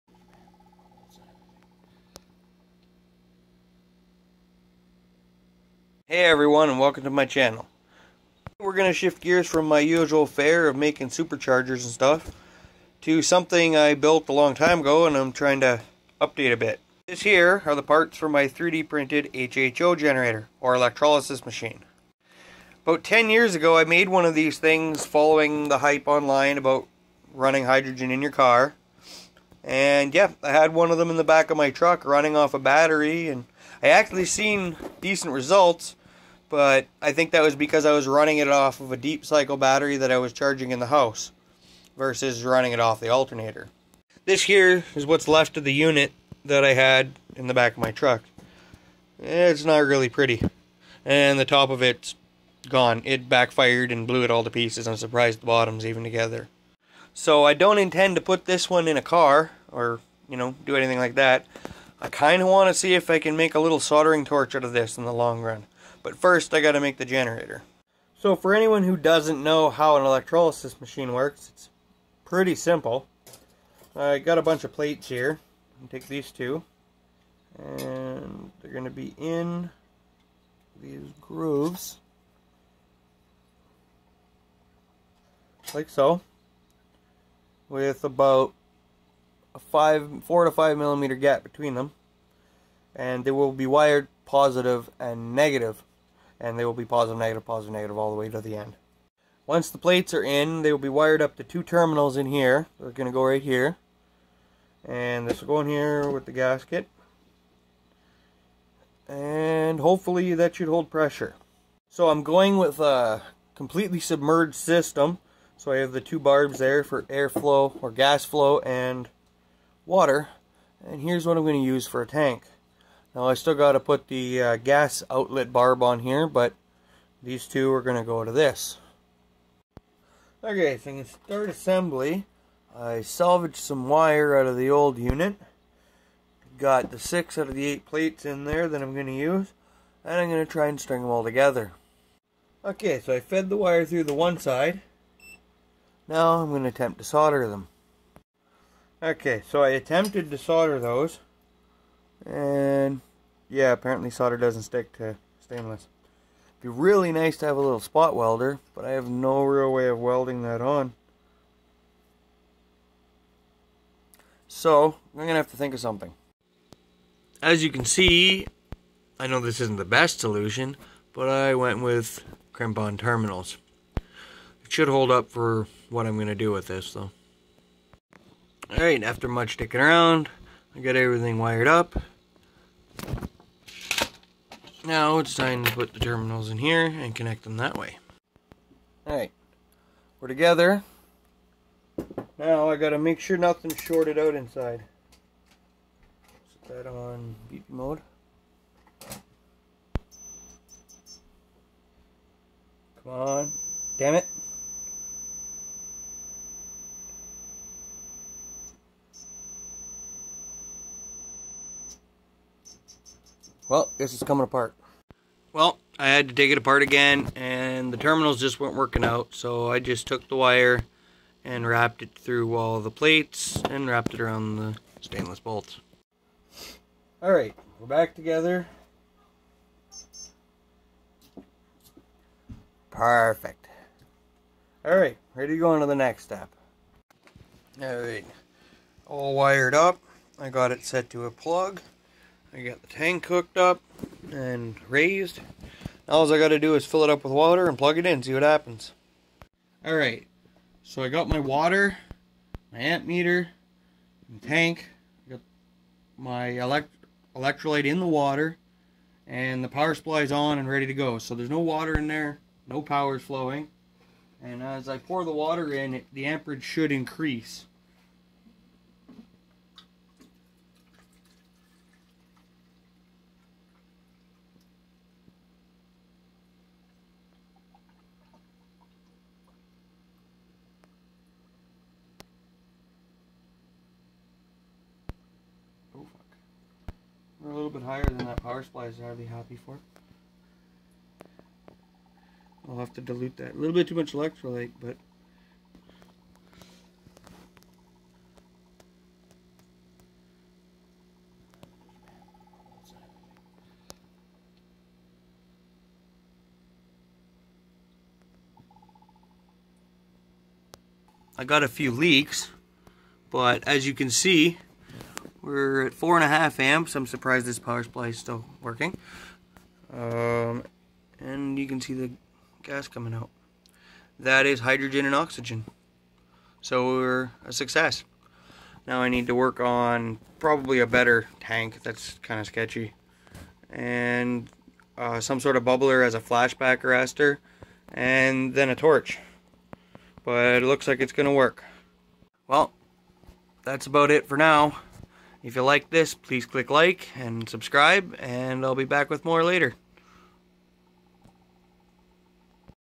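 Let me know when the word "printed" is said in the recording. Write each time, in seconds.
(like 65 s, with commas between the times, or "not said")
18 s.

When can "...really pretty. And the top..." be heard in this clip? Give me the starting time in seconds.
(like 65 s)
49 s.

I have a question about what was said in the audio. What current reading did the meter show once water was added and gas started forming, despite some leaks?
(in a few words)
4.5 amps.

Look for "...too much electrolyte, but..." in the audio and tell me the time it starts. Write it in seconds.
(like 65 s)
293 s.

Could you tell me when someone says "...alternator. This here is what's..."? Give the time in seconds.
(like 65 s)
43 s.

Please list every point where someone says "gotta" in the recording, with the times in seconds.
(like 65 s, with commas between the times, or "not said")
66 s, 192 s.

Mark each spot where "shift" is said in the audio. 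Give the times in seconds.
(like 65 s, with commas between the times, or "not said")
8 s.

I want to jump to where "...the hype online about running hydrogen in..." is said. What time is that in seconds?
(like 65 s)
25 s.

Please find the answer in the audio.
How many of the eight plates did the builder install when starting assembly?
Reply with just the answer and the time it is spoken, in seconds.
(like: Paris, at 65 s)
6, at 136 s.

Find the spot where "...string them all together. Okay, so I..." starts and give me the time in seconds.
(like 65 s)
140 s.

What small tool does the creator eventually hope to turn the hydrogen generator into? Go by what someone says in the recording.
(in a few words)
soldering torch.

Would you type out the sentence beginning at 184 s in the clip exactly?
Now it's time to put the terminals in here and connect them that way.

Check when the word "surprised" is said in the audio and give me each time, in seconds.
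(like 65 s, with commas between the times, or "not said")
54 s, 317 s.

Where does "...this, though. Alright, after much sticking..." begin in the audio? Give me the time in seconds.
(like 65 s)
176 s.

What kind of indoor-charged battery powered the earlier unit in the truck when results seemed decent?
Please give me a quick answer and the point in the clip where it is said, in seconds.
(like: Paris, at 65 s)
deep cycle battery, at 38 s.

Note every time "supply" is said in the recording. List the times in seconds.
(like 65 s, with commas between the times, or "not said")
259 s, 288 s, 317 s.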